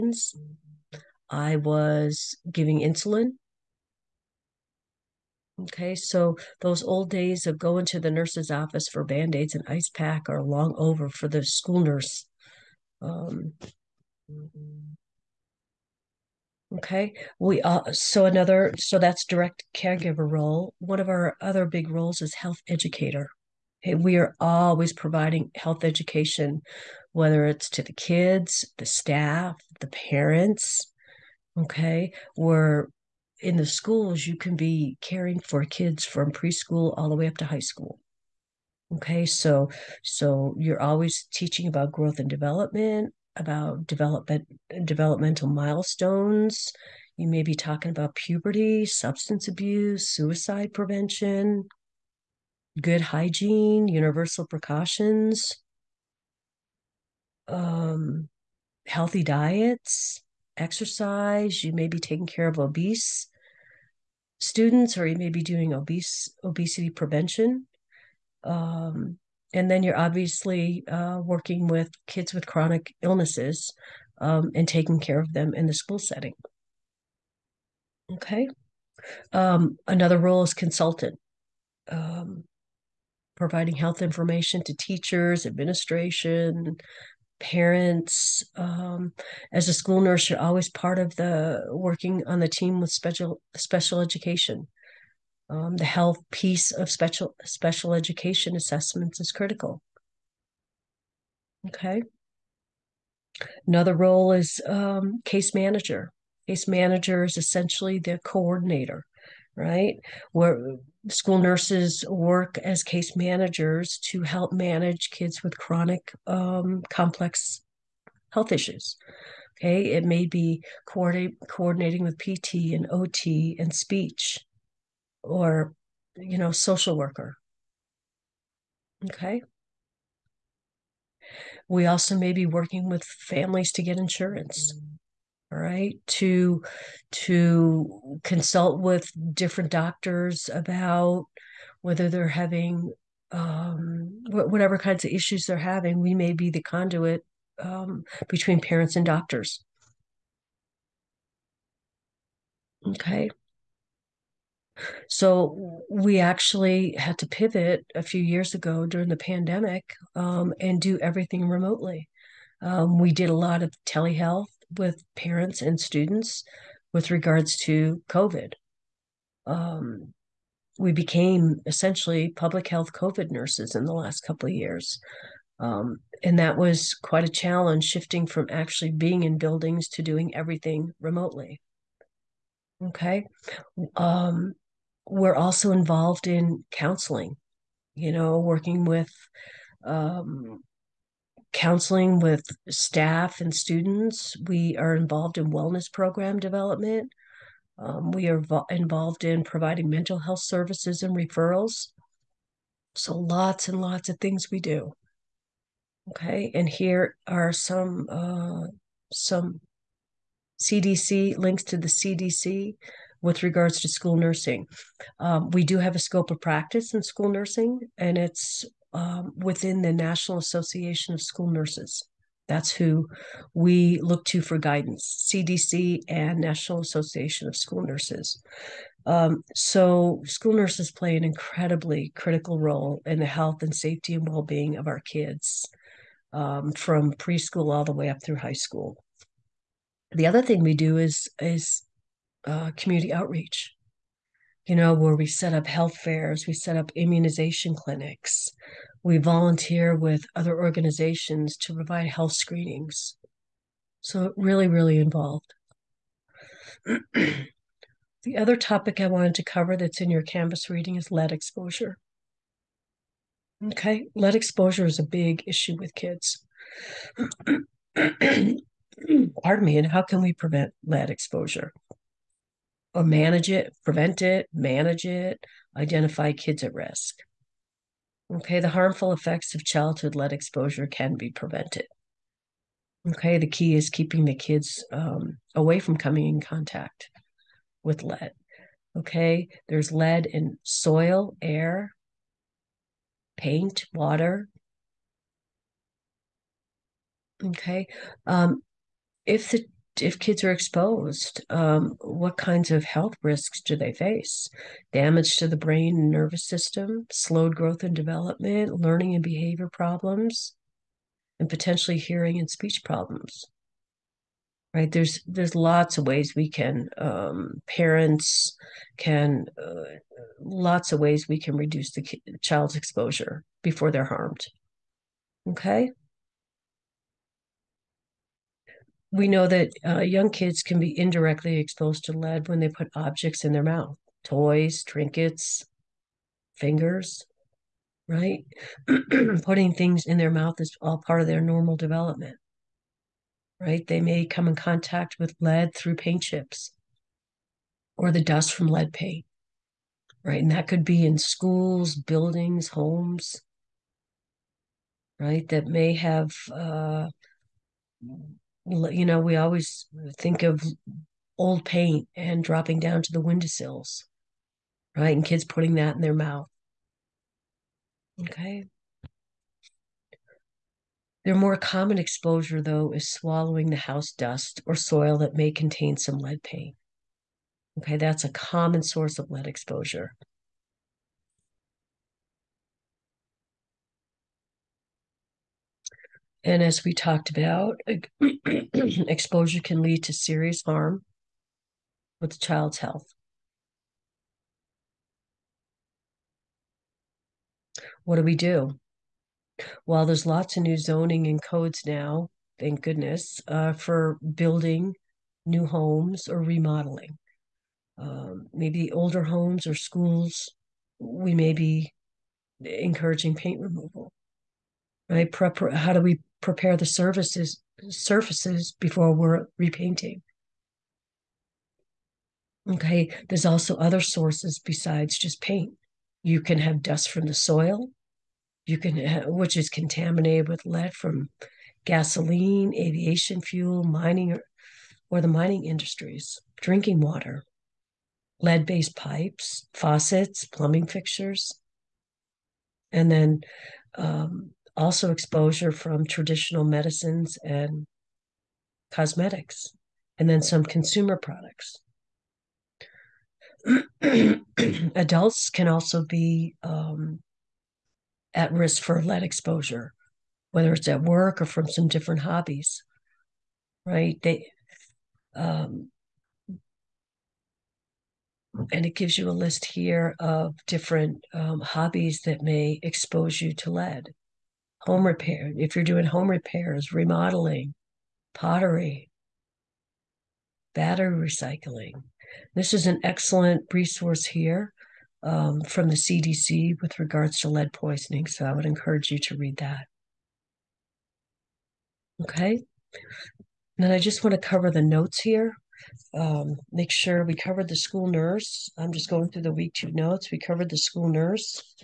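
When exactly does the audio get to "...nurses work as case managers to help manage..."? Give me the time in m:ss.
1:51.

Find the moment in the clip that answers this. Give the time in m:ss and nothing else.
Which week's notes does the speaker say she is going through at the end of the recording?
8:19.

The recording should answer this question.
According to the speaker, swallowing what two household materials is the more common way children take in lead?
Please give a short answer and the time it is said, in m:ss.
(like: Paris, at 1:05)
House dust or soil, at 6:13.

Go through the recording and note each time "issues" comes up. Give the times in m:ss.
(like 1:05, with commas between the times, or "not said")
1:58, 2:25, 4:25.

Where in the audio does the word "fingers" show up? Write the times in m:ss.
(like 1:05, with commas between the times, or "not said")
5:36.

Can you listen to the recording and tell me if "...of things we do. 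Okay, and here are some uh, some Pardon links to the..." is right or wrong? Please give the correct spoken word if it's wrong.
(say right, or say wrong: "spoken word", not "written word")
wrong: "CDC", not "Pardon".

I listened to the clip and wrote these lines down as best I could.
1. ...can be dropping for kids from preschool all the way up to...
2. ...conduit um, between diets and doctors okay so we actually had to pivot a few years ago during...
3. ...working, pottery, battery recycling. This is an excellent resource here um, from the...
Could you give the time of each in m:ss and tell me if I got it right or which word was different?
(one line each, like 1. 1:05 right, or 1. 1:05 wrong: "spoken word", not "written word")
1. 0:34 wrong: "caring", not "dropping"
2. 2:26 wrong: "parents", not "diets"
3. 7:56 wrong: "remodeling", not "working".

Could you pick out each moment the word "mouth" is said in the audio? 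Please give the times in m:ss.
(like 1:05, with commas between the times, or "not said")
5:33, 5:40, 6:06.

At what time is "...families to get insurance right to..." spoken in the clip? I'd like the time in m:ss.
2:13.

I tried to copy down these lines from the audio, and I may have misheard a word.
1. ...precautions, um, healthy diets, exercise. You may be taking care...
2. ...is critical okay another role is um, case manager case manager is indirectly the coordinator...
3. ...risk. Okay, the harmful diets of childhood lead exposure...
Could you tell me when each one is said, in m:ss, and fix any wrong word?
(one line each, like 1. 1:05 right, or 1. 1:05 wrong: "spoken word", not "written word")
1. 0:54 right
2. 1:39 wrong: "essentially", not "indirectly"
3. 4:36 wrong: "effects", not "diets".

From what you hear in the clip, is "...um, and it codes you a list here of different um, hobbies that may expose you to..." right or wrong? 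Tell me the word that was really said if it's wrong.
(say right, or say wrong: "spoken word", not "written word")
wrong: "gives", not "codes".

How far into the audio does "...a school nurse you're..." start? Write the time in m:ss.
1:29.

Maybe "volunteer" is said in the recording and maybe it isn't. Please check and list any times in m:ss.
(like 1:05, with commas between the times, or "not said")
4:09.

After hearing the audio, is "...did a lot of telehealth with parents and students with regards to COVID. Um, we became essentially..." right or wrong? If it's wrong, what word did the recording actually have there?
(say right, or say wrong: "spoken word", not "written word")
right.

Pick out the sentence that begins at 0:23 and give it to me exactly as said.
Okay, we are always providing health education whether it's to the kids, the staff, the parents.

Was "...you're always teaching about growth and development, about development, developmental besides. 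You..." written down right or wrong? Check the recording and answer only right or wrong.
wrong.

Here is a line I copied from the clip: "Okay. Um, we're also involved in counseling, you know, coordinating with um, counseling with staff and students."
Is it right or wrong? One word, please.
wrong.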